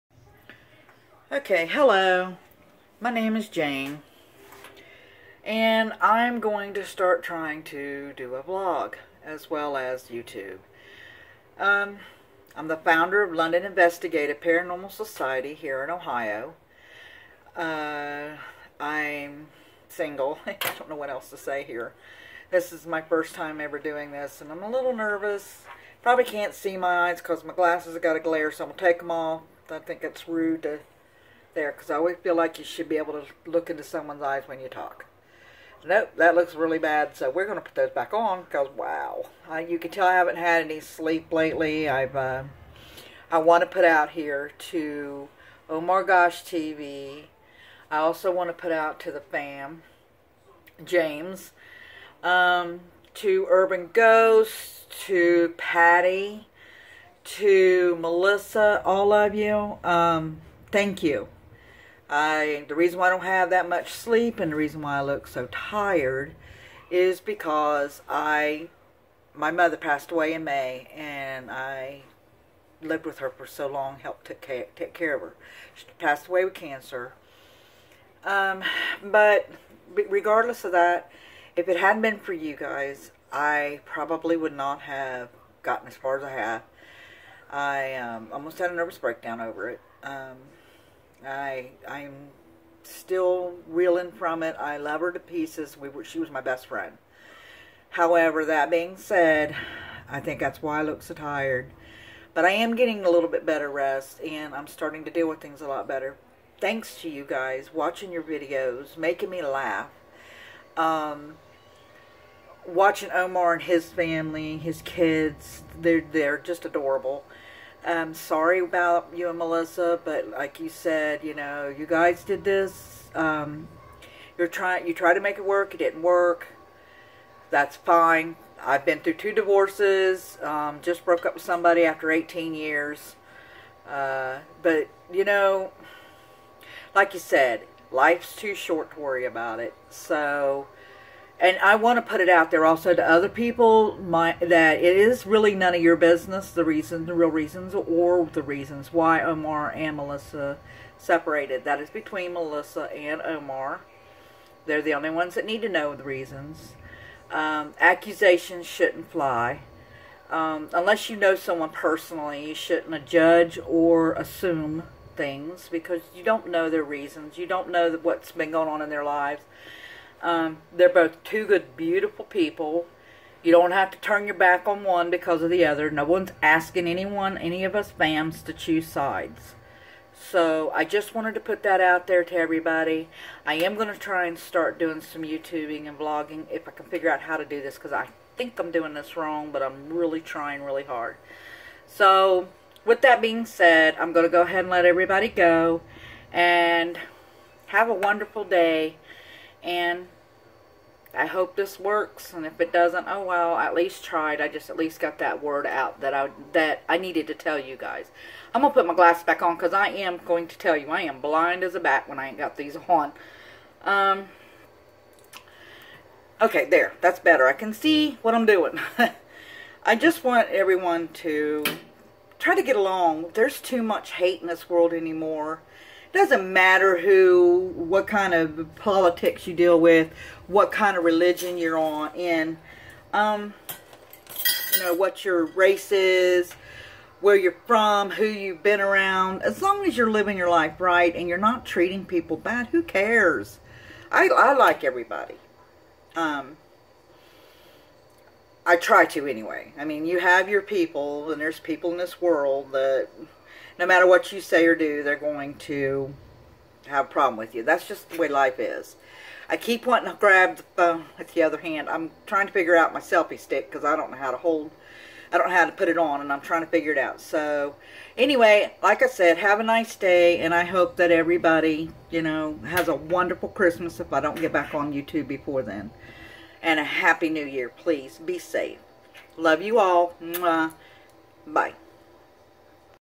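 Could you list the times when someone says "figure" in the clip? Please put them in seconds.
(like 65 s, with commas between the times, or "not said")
186 s, 262 s, 266 s.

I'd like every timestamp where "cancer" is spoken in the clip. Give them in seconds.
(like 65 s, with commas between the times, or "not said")
76 s.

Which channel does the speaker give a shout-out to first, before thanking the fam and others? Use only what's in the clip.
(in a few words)
Oh My Gosh TV.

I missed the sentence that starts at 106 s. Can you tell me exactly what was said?
Thanks to you guys watching your videos, making me laugh.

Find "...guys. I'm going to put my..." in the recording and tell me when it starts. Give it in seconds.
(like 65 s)
207 s.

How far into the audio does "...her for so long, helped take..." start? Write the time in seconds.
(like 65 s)
73 s.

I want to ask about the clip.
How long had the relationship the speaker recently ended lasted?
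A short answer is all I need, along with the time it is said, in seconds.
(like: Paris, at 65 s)
18 years, at 132 s.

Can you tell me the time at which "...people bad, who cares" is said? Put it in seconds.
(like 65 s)
242 s.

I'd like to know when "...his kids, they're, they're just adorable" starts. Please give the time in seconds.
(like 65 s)
114 s.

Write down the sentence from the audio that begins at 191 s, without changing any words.
So with that being said, I'm going to go ahead and let everybody go.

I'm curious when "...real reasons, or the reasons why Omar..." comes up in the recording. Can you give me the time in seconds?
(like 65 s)
147 s.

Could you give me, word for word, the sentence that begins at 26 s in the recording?
Probably can't see my eyes because my glasses have got a glare, so I'm going to take them off.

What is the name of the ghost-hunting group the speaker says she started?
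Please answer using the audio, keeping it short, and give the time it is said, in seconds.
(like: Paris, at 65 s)
London Investigative Paranormal Society, at 13 s.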